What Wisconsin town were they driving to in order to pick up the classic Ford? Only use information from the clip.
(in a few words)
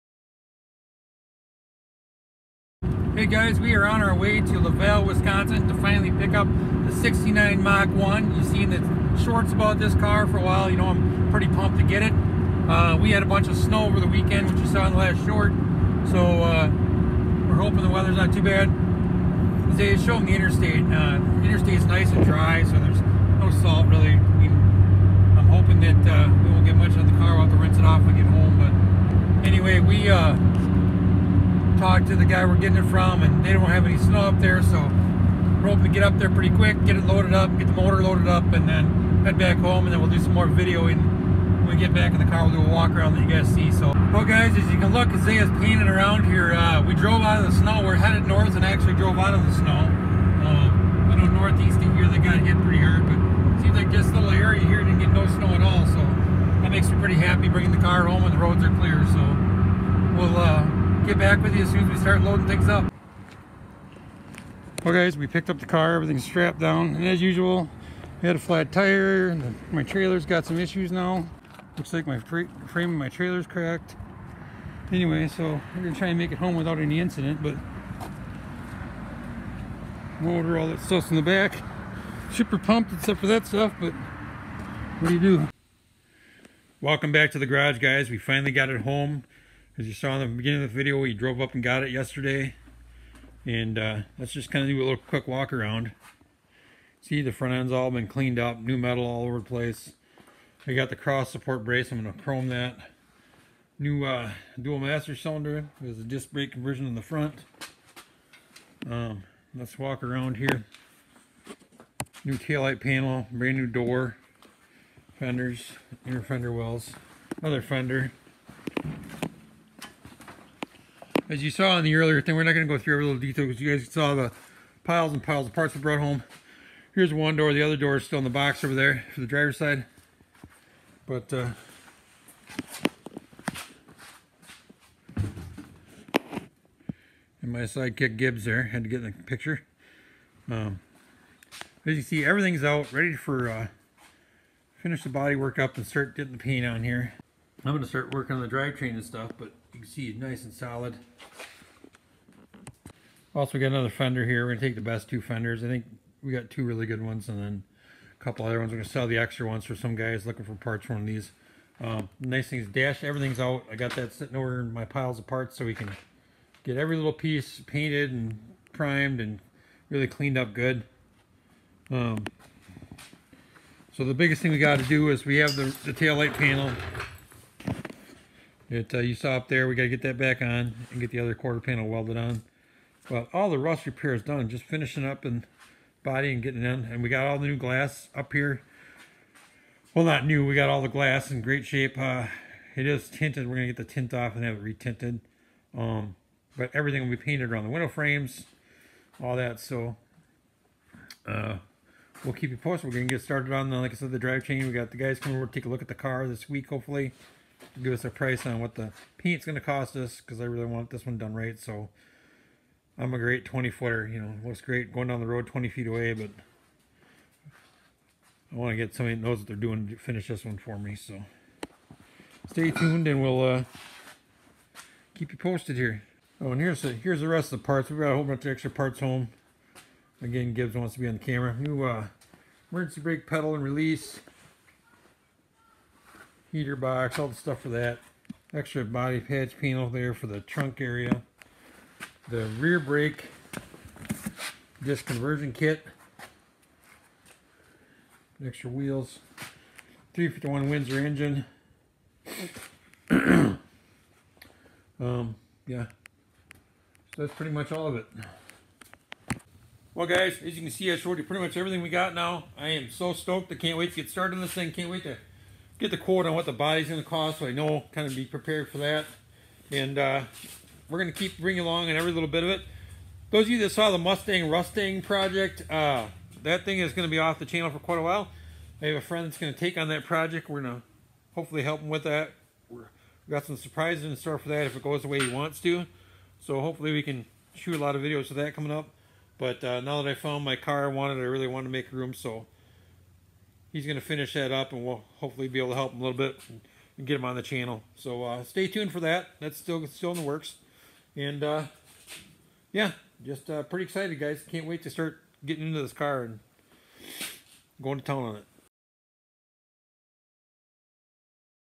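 La Valle.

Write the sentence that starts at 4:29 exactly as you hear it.
And uh, we're going to keep bringing along on every little bit of it.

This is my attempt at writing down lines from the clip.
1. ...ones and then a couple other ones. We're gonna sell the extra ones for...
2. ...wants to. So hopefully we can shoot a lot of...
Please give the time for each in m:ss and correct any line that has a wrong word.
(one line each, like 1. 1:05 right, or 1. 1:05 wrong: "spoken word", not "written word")
1. 2:37 right
2. 4:45 right.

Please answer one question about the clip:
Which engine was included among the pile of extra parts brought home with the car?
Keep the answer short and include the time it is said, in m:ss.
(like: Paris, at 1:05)
351 Windsor, at 4:10.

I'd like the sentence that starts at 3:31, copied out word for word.
So I'm a great 20 footer.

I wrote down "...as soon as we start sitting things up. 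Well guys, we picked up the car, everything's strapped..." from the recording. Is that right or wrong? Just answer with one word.
wrong.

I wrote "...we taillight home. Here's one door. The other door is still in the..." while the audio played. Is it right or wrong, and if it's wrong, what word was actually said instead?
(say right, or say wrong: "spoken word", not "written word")
wrong: "brought", not "taillight".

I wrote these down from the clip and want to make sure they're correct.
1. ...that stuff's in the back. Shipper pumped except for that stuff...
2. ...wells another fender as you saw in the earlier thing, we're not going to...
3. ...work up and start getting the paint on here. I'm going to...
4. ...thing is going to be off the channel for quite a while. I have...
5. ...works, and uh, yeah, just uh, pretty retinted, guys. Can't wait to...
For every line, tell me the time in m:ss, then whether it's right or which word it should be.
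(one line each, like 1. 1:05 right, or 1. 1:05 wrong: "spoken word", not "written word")
1. 1:20 right
2. 1:56 right
3. 2:25 right
4. 4:36 right
5. 5:00 wrong: "excited", not "retinted".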